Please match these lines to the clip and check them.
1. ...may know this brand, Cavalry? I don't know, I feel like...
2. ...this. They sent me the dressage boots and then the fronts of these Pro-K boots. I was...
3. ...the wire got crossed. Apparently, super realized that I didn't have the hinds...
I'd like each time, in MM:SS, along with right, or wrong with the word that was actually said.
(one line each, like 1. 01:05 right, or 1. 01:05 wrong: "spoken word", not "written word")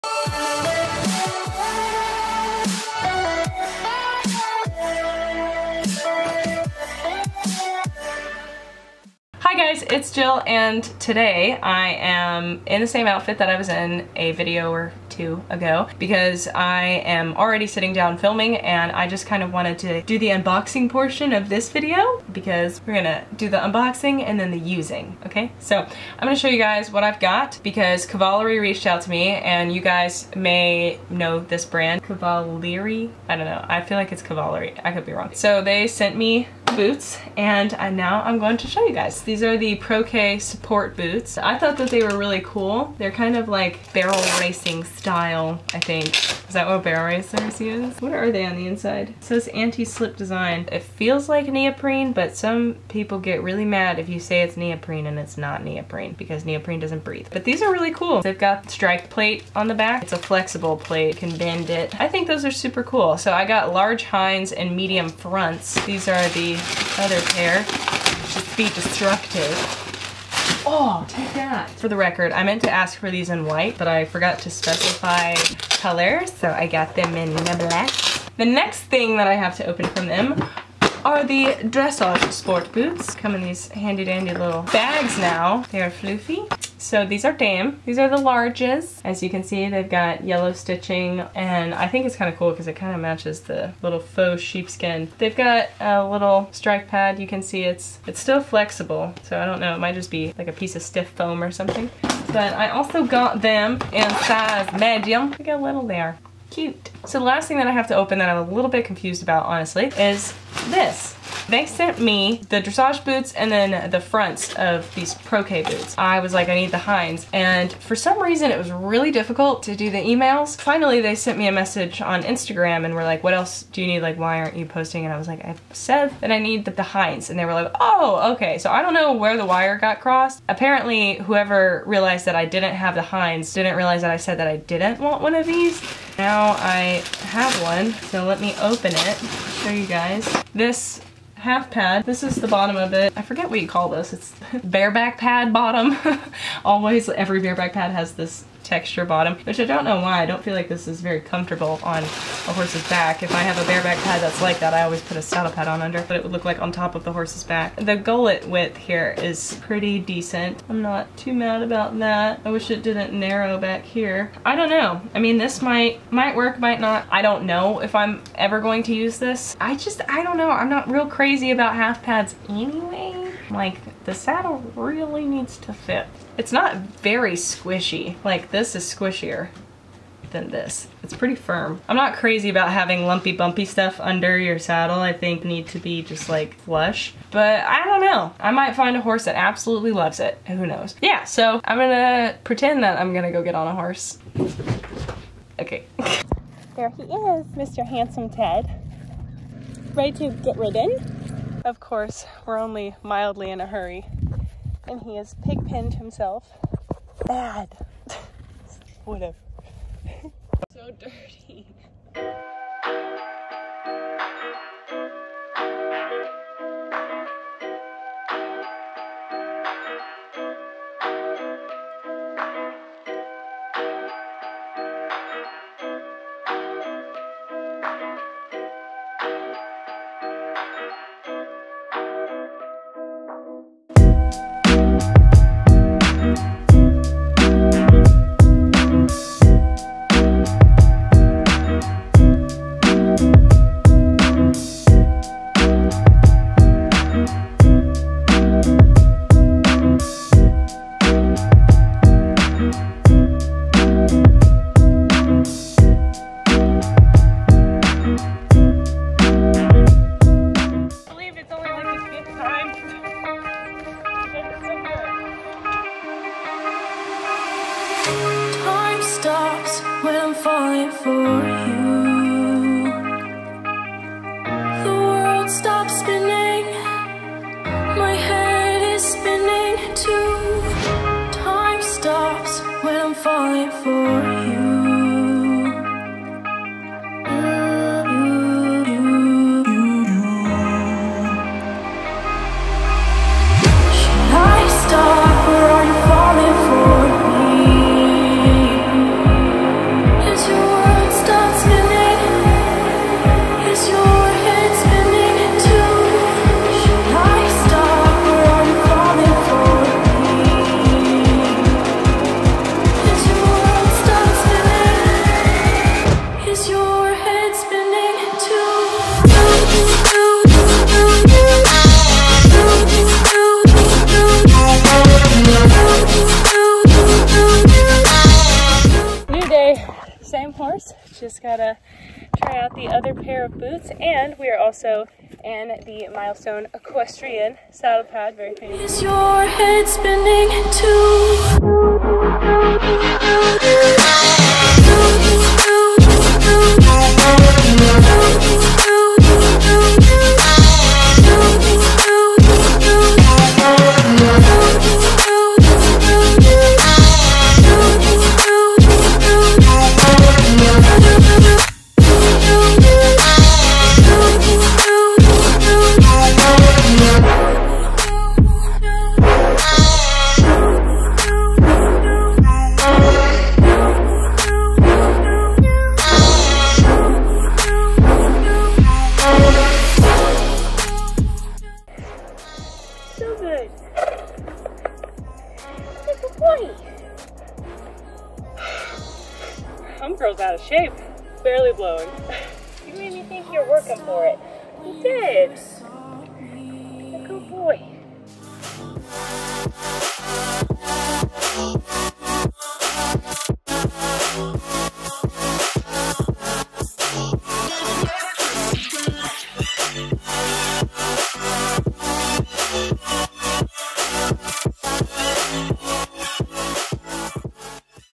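1. 00:30 right
2. 01:50 right
3. 02:09 wrong: "whoever", not "super".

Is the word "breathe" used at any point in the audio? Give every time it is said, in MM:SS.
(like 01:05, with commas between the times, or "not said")
00:57.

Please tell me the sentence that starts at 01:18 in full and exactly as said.
The next thing that I have to open from them are the dressage sport boots.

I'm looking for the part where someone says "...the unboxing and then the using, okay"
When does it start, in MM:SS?
00:23.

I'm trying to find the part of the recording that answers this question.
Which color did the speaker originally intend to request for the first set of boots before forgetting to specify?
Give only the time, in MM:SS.
01:13.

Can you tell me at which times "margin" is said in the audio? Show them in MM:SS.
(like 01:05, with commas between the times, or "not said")
not said.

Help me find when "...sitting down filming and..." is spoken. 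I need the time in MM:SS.
00:17.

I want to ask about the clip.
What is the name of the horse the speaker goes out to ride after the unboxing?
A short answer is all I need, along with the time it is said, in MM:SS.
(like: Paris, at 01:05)
Ted, at 03:18.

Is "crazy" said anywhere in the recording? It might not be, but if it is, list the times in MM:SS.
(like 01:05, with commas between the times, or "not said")
02:51, 03:02.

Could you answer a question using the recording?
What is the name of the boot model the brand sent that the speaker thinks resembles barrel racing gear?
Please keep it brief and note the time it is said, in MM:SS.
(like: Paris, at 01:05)
Pro K support boots, at 00:39.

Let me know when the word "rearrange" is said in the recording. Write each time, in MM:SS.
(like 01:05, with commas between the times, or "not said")
not said.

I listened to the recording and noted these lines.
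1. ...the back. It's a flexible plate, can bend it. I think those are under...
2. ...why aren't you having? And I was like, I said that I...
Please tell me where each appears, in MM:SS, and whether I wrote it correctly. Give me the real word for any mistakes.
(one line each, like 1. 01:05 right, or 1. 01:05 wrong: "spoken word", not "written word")
1. 00:59 wrong: "super", not "under"
2. 02:04 wrong: "posting", not "having".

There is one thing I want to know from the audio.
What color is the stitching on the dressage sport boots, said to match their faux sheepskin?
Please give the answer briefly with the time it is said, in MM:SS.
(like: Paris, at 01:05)
Yellow, at 01:30.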